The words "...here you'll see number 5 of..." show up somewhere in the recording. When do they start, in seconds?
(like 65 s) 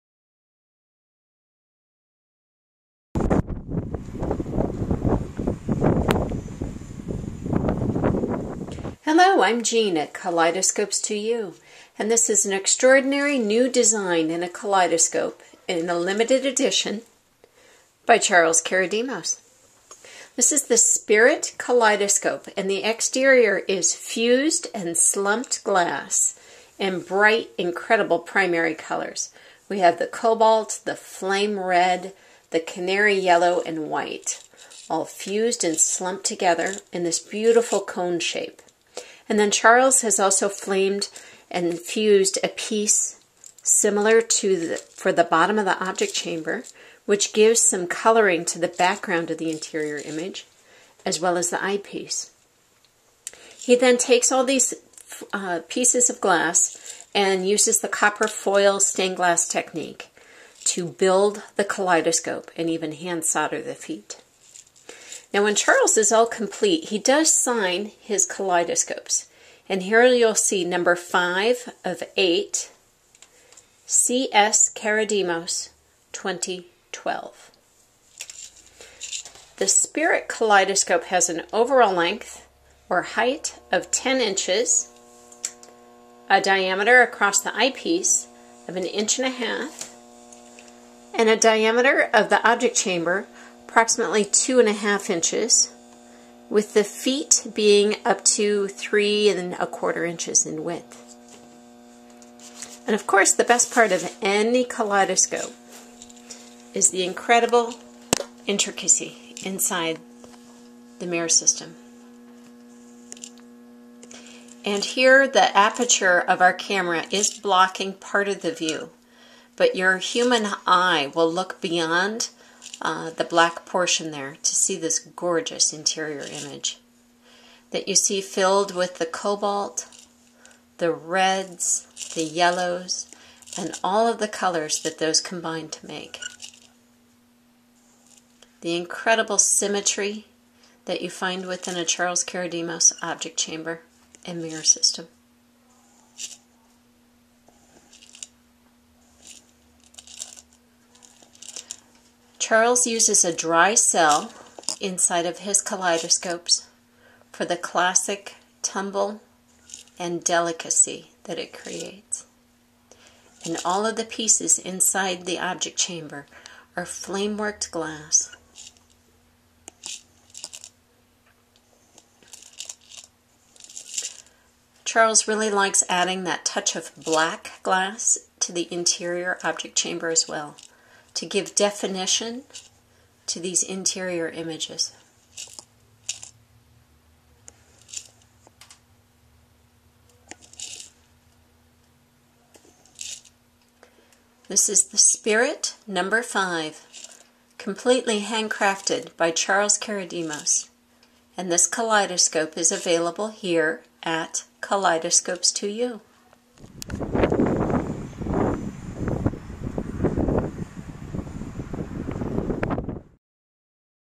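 69 s.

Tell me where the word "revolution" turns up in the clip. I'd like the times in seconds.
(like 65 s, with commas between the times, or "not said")
not said.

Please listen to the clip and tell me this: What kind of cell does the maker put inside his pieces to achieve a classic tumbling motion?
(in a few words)
dry cell.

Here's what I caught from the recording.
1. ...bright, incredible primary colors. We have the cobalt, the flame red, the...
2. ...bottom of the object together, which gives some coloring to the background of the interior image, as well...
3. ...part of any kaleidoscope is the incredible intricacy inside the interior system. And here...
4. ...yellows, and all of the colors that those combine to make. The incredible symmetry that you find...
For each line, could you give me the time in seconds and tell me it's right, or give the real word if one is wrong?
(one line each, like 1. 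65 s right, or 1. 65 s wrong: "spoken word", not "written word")
1. 27 s right
2. 45 s wrong: "chamber", not "together"
3. 103 s wrong: "mirror", not "interior"
4. 132 s right.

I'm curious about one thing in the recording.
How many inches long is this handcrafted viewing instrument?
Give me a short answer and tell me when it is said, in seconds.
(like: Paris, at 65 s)
10 inches, at 83 s.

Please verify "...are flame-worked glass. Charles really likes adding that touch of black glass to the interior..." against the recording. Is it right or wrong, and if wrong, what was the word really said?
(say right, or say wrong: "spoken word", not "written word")
right.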